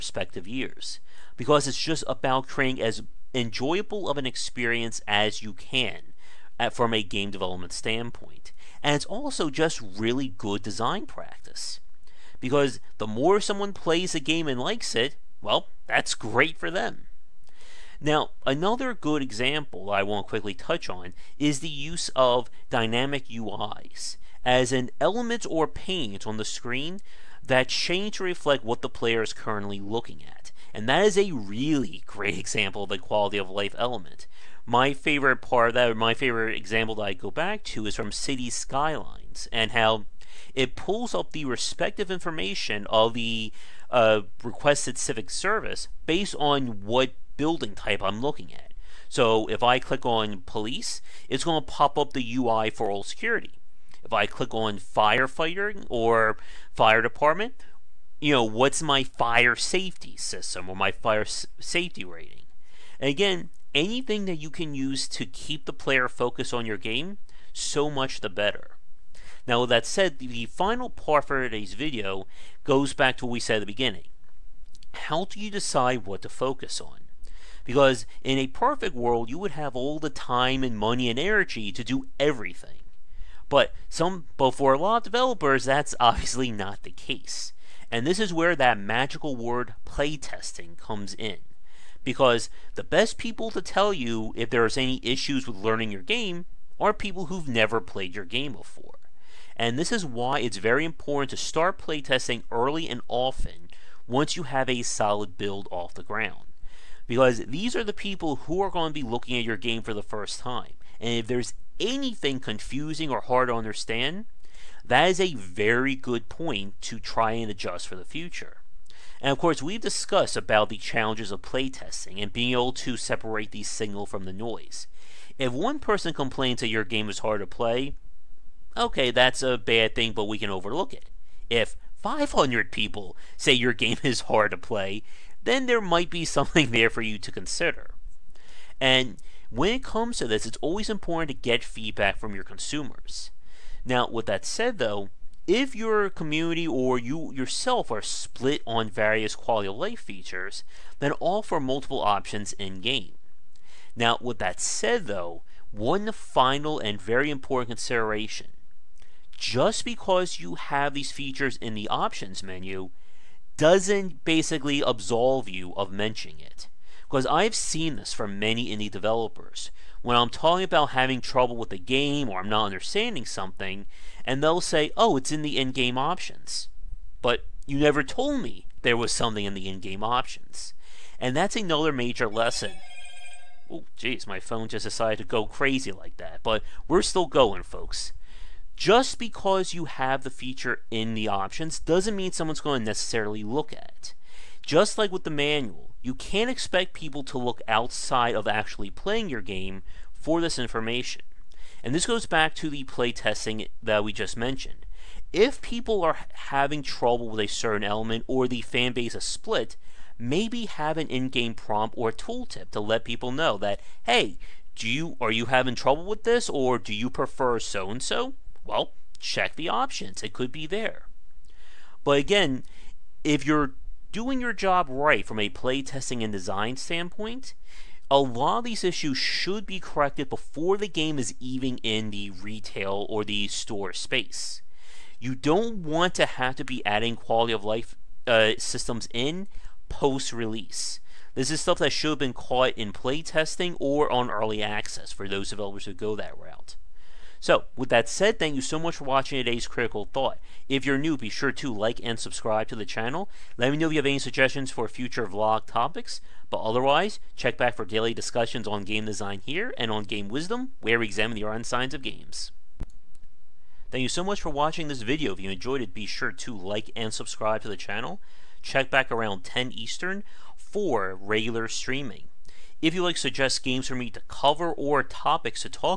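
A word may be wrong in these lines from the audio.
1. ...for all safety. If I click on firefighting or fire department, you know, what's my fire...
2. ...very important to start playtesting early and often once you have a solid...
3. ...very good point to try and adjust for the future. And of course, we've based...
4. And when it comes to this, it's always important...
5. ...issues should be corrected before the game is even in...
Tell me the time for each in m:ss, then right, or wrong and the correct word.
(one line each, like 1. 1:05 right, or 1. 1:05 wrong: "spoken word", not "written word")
1. 0:52 wrong: "security", not "safety"
2. 1:40 right
3. 1:55 wrong: "discussed", not "based"
4. 2:18 right
5. 3:48 right.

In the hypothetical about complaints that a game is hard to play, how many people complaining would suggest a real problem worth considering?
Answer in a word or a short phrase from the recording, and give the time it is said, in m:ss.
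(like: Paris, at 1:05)
500, at 2:12.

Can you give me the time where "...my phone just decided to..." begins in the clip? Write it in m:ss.
3:04.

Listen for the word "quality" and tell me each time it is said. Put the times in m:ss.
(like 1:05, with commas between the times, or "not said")
0:32, 2:29, 3:57.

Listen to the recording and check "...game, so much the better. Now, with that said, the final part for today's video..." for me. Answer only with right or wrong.
right.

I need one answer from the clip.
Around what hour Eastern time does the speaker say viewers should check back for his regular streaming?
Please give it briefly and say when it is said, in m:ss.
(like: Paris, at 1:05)
10, at 4:29.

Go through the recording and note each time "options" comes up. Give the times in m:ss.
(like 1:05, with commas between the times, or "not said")
2:31, 2:41, 2:55, 3:00, 3:11, 3:39.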